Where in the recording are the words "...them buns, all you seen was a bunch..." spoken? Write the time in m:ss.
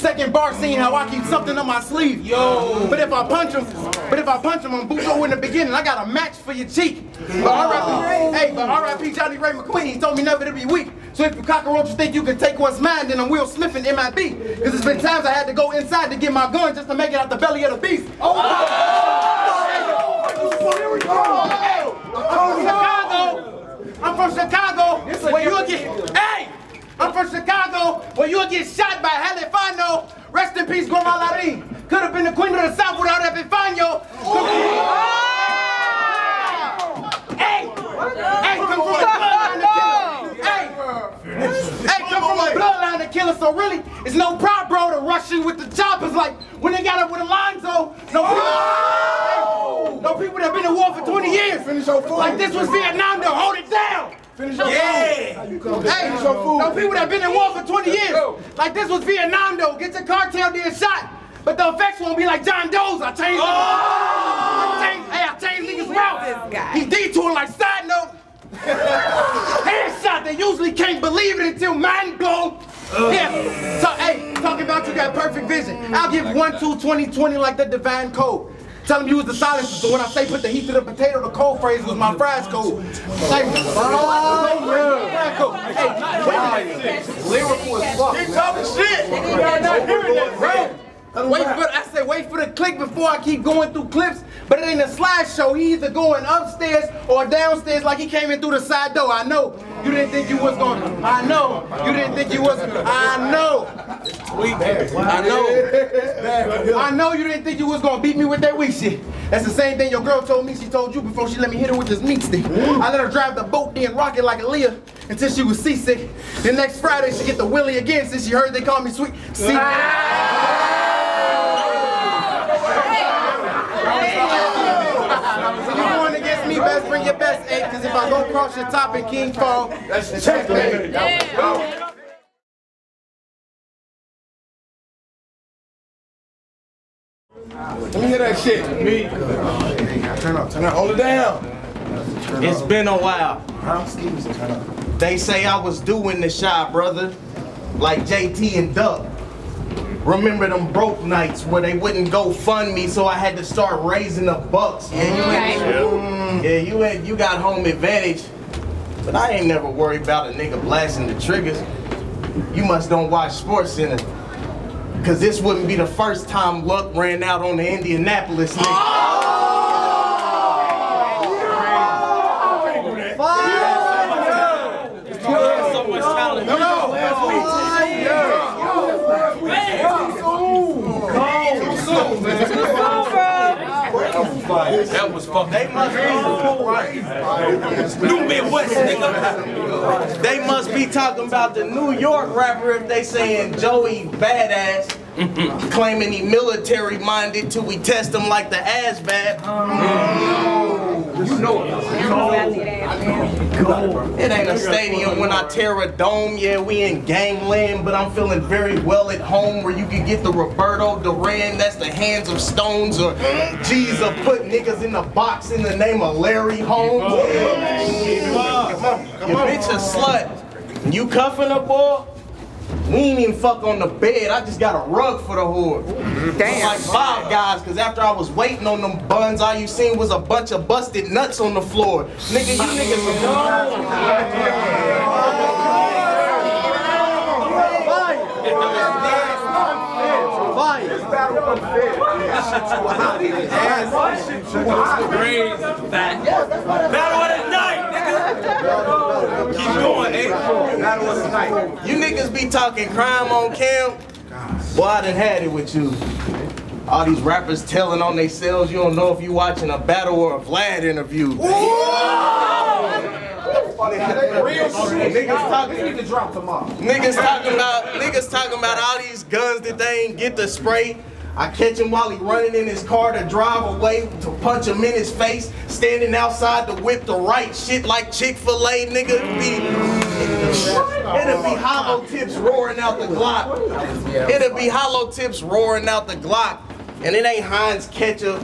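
3:48.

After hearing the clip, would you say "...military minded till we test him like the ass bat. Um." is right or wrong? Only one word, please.
right.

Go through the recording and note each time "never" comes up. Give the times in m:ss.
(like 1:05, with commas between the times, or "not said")
0:10, 2:39.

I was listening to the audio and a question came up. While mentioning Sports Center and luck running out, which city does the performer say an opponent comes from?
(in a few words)
Indianapolis.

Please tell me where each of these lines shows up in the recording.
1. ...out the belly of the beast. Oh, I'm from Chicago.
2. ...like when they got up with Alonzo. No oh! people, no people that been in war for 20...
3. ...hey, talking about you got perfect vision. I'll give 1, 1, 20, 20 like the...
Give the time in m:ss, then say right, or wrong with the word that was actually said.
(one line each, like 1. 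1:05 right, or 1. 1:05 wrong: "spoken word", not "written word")
1. 0:17 right
2. 0:46 right
3. 1:14 wrong: "2", not "1".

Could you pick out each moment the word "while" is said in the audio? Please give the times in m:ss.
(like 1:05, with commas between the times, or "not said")
2:22, 4:31.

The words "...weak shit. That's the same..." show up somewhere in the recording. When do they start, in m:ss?
1:48.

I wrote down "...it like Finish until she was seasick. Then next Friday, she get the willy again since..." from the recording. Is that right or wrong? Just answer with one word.
wrong.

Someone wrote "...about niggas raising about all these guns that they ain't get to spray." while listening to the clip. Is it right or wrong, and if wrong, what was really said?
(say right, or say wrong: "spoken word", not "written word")
wrong: "talking", not "raising".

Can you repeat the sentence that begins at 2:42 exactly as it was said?
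You must don't watch Sports Center.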